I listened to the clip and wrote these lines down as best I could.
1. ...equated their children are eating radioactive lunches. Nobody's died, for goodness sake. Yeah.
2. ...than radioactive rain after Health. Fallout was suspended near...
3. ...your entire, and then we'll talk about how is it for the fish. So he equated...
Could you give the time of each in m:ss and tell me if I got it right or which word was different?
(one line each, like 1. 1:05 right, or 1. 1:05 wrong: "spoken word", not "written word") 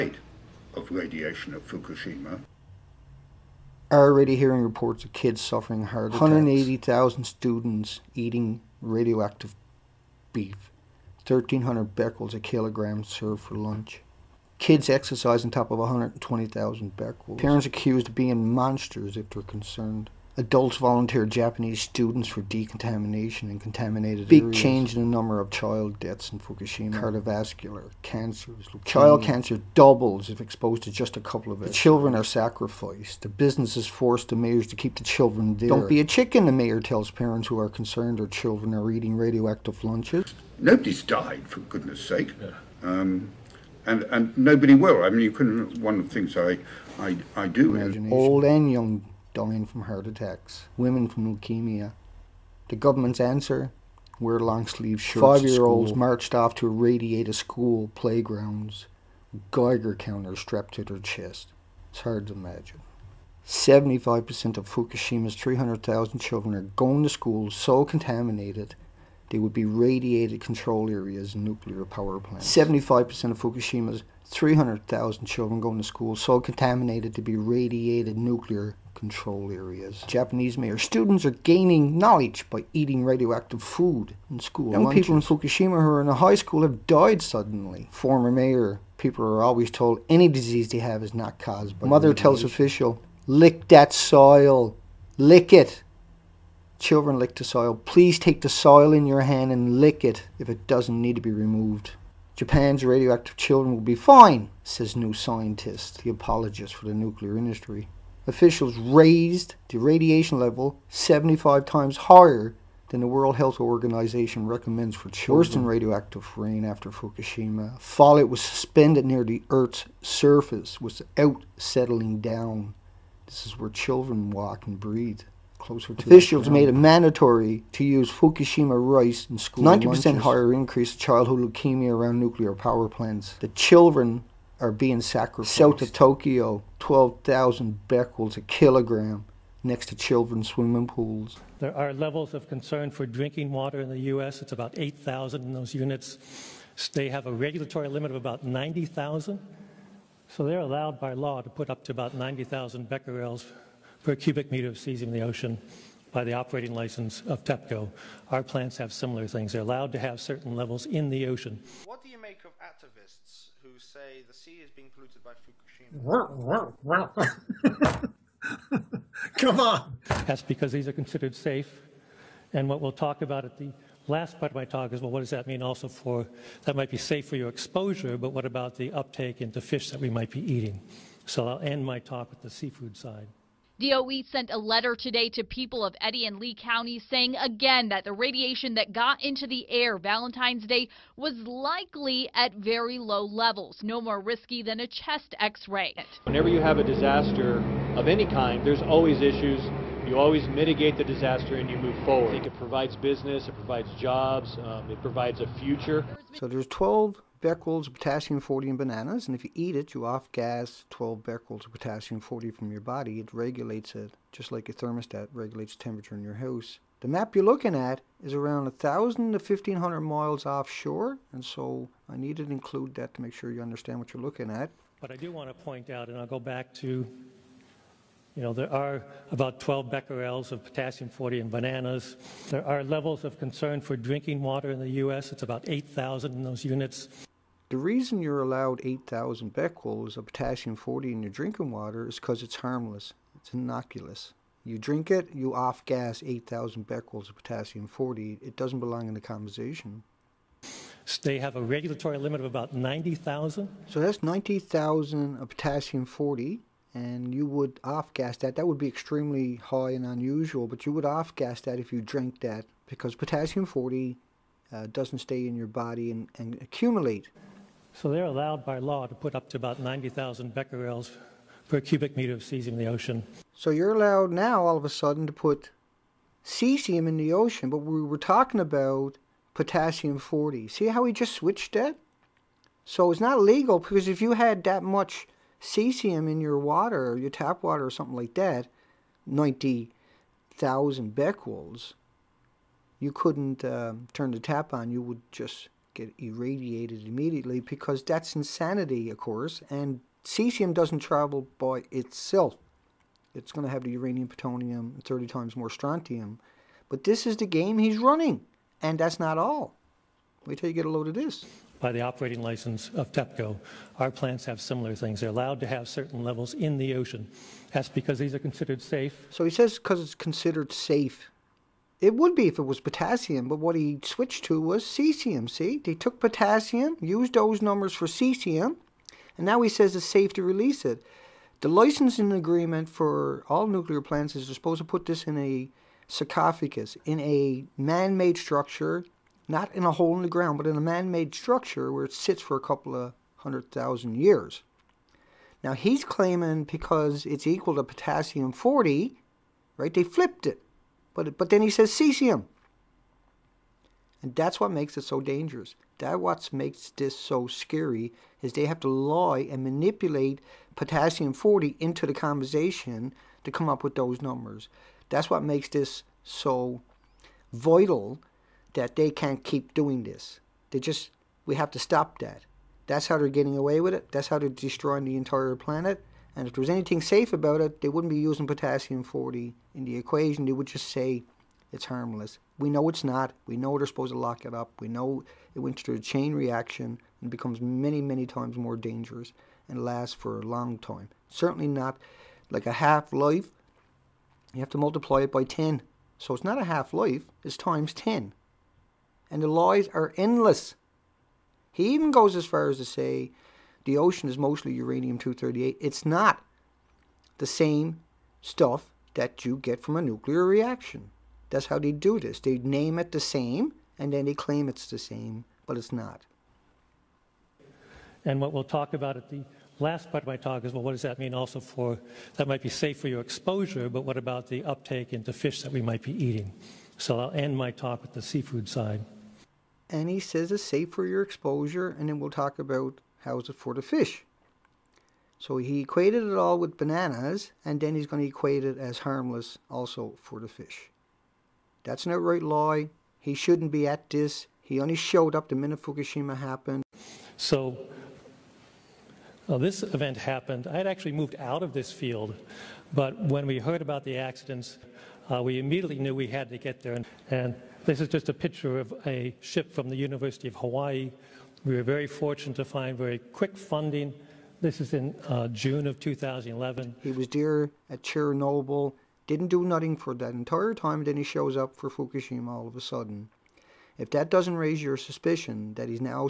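1. 0:37 wrong: "concerned", not "equated"
2. 1:55 wrong: "Fukushima", not "Health"
3. 7:11 wrong: "exposure", not "entire".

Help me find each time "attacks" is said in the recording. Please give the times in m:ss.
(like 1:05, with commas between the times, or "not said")
0:06, 0:50.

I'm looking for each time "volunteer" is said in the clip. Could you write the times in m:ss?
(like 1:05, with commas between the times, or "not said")
0:20.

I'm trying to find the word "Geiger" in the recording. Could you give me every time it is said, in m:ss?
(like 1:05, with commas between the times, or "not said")
0:59.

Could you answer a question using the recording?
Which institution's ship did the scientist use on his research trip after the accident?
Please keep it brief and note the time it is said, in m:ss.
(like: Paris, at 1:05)
University of Hawaii, at 7:39.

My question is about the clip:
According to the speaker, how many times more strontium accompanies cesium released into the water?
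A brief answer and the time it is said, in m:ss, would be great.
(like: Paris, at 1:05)
30 times, at 5:05.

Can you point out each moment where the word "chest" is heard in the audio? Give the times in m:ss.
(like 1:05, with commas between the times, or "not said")
1:00, 3:14.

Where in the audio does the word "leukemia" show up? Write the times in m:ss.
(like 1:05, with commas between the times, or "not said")
0:28, 0:51, 2:11.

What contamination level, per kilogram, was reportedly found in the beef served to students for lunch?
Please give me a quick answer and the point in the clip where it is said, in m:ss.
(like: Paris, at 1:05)
1,300 becquerels, at 0:11.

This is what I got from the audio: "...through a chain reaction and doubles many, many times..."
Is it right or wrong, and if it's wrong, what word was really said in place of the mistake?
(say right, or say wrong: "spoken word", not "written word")
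wrong: "becomes", not "doubles".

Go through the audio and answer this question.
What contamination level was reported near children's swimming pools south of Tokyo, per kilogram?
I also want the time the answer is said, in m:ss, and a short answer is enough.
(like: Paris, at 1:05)
12,000 becquerels, at 2:16.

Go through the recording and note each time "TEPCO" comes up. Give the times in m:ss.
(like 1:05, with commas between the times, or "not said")
2:37, 5:13.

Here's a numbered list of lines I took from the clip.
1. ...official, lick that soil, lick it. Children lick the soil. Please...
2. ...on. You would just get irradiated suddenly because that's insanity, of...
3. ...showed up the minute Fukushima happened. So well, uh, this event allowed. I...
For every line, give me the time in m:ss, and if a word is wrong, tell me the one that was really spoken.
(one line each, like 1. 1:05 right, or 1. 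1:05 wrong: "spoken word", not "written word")
1. 1:32 right
2. 4:54 wrong: "immediately", not "suddenly"
3. 7:24 wrong: "happened", not "allowed".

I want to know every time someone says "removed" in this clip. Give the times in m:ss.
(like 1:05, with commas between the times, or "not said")
1:41.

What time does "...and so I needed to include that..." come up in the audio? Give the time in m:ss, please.
3:41.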